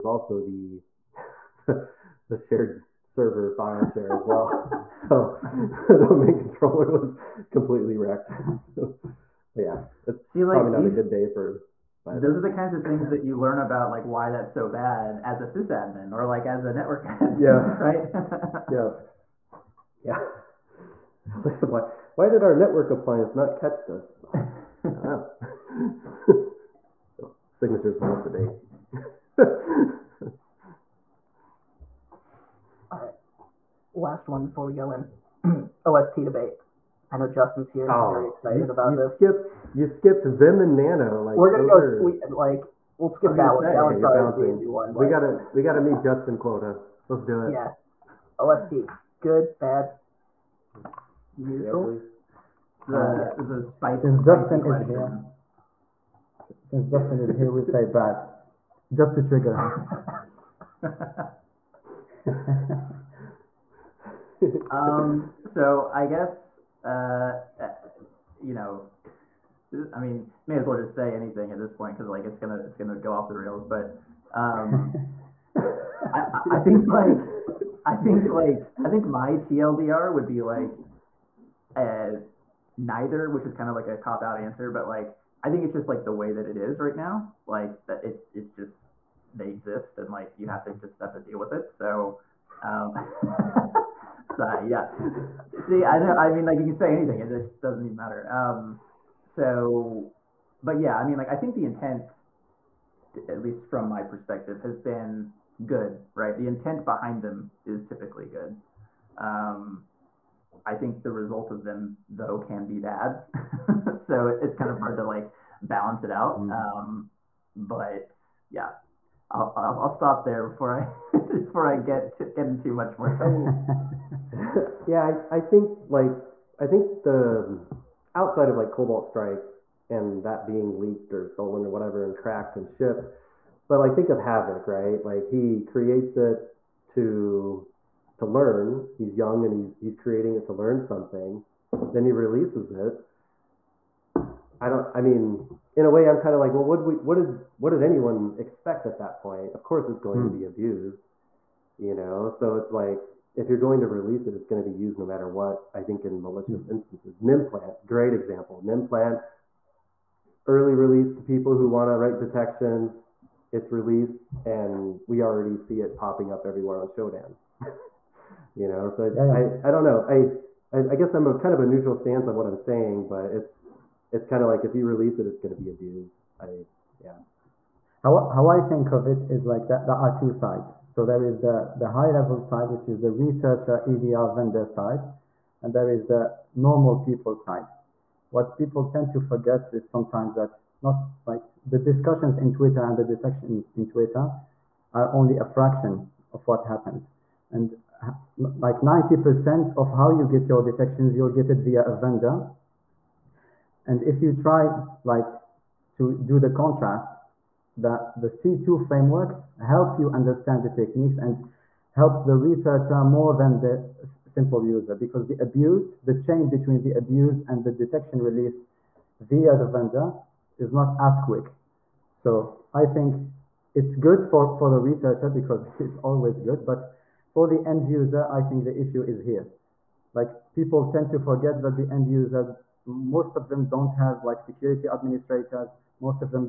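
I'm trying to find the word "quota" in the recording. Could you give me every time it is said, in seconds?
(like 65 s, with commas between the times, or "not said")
46 s.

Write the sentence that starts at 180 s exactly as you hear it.
So there is the, the high level side, which is the researcher EDR vendor side, and there is the normal people side.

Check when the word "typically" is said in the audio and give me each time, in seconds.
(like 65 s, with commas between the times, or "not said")
107 s.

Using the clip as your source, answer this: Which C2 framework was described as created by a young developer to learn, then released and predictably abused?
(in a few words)
Havoc.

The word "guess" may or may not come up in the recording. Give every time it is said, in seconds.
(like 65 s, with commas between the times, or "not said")
66 s, 170 s.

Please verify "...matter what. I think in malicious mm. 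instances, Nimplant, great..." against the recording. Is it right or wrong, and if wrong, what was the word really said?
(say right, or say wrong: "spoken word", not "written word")
right.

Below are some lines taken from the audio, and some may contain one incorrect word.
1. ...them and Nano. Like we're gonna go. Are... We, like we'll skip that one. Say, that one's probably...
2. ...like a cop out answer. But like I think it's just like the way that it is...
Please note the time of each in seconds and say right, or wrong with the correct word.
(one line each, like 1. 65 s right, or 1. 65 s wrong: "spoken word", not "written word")
1. 40 s right
2. 83 s right.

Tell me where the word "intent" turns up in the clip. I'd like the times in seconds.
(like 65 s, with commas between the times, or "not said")
101 s, 106 s.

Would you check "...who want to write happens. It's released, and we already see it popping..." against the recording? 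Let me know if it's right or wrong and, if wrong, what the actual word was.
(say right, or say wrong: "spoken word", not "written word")
wrong: "detections", not "happens".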